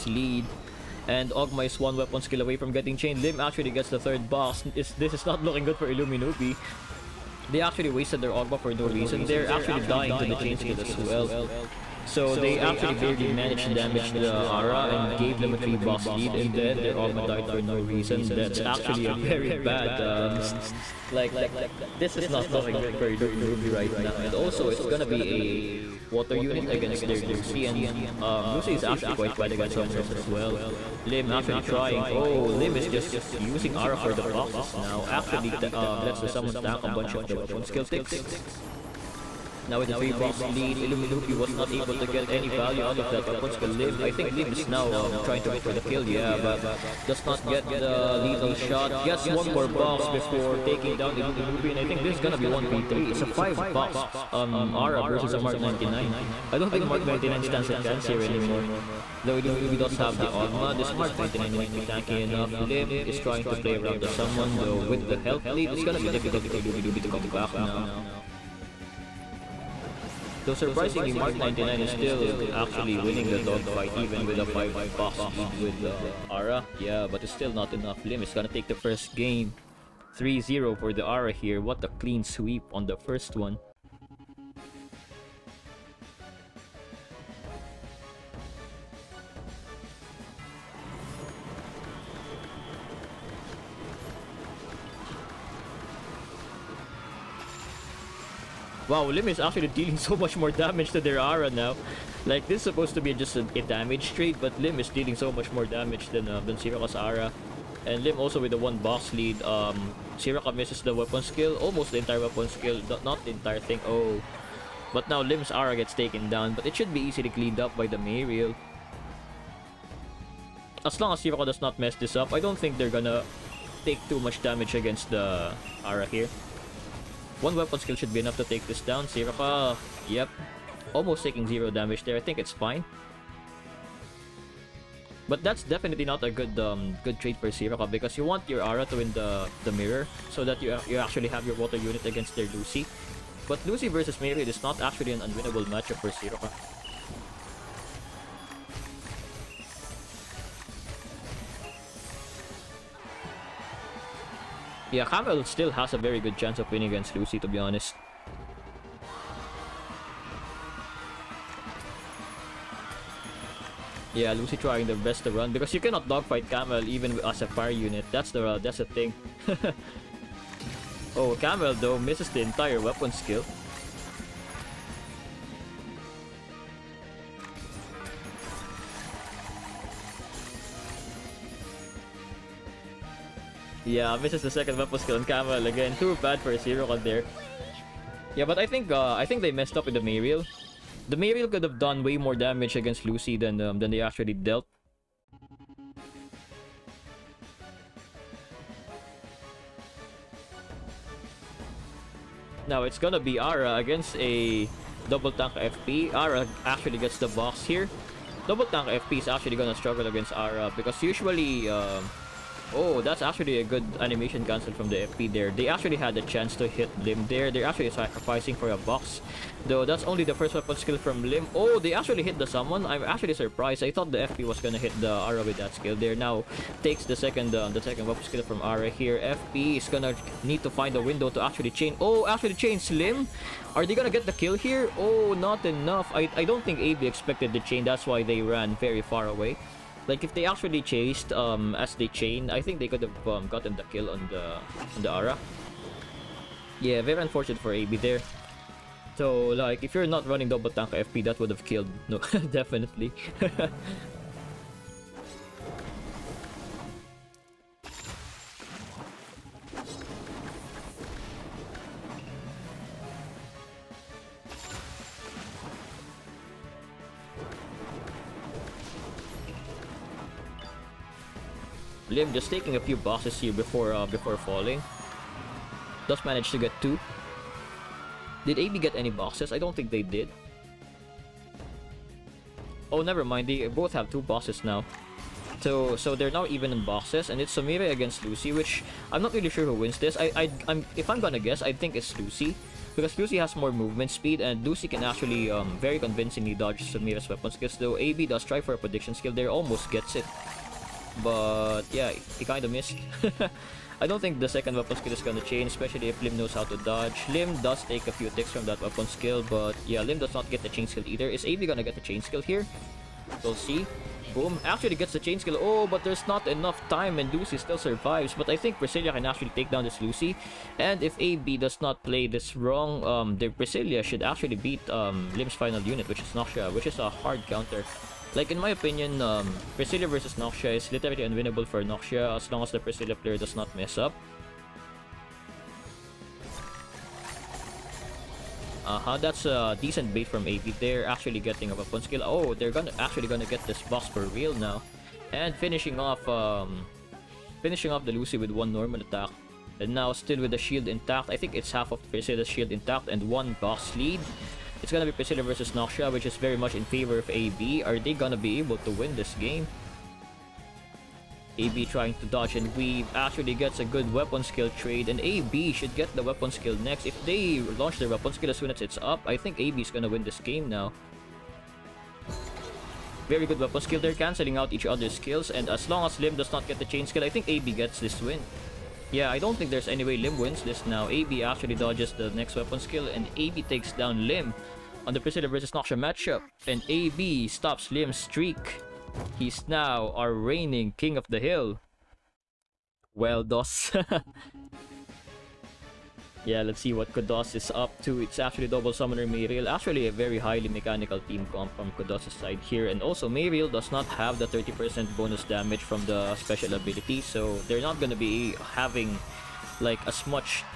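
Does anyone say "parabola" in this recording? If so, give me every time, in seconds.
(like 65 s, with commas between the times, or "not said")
not said.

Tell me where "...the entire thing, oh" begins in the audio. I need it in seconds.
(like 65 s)
113 s.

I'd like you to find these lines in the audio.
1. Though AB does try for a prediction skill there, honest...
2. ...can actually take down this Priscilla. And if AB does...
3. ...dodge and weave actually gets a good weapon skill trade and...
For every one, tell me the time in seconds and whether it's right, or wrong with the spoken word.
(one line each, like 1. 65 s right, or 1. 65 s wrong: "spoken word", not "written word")
1. 297 s wrong: "almost", not "honest"
2. 319 s wrong: "Lucy", not "Priscilla"
3. 362 s right.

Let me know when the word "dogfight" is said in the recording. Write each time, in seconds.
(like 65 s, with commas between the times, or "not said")
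73 s, 166 s.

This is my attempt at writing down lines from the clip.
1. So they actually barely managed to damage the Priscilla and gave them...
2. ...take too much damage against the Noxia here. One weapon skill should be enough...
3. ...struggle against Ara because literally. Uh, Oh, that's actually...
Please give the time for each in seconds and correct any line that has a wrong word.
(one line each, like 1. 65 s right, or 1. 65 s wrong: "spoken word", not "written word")
1. 12 s wrong: "Ara", not "Priscilla"
2. 123 s wrong: "Ara", not "Noxia"
3. 209 s wrong: "usually", not "literally".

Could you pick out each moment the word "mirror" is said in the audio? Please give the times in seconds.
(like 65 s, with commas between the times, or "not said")
139 s, 144 s.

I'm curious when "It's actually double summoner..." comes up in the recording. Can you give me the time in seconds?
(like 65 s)
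398 s.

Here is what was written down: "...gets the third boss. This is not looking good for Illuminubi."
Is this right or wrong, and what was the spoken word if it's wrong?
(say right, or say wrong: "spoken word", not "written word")
right.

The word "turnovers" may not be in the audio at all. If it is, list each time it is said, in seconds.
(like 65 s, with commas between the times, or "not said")
not said.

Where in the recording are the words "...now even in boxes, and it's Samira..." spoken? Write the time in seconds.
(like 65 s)
286 s.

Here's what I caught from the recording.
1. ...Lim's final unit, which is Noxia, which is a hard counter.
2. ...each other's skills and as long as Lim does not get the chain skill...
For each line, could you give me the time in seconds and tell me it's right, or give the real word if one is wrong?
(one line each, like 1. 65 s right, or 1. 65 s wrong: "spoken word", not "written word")
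1. 325 s right
2. 374 s right.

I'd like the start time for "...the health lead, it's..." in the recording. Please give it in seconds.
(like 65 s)
65 s.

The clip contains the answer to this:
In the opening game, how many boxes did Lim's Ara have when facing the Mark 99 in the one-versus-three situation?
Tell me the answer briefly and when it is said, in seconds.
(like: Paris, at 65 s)
5, at 53 s.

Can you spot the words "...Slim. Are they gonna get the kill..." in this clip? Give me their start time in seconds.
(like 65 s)
232 s.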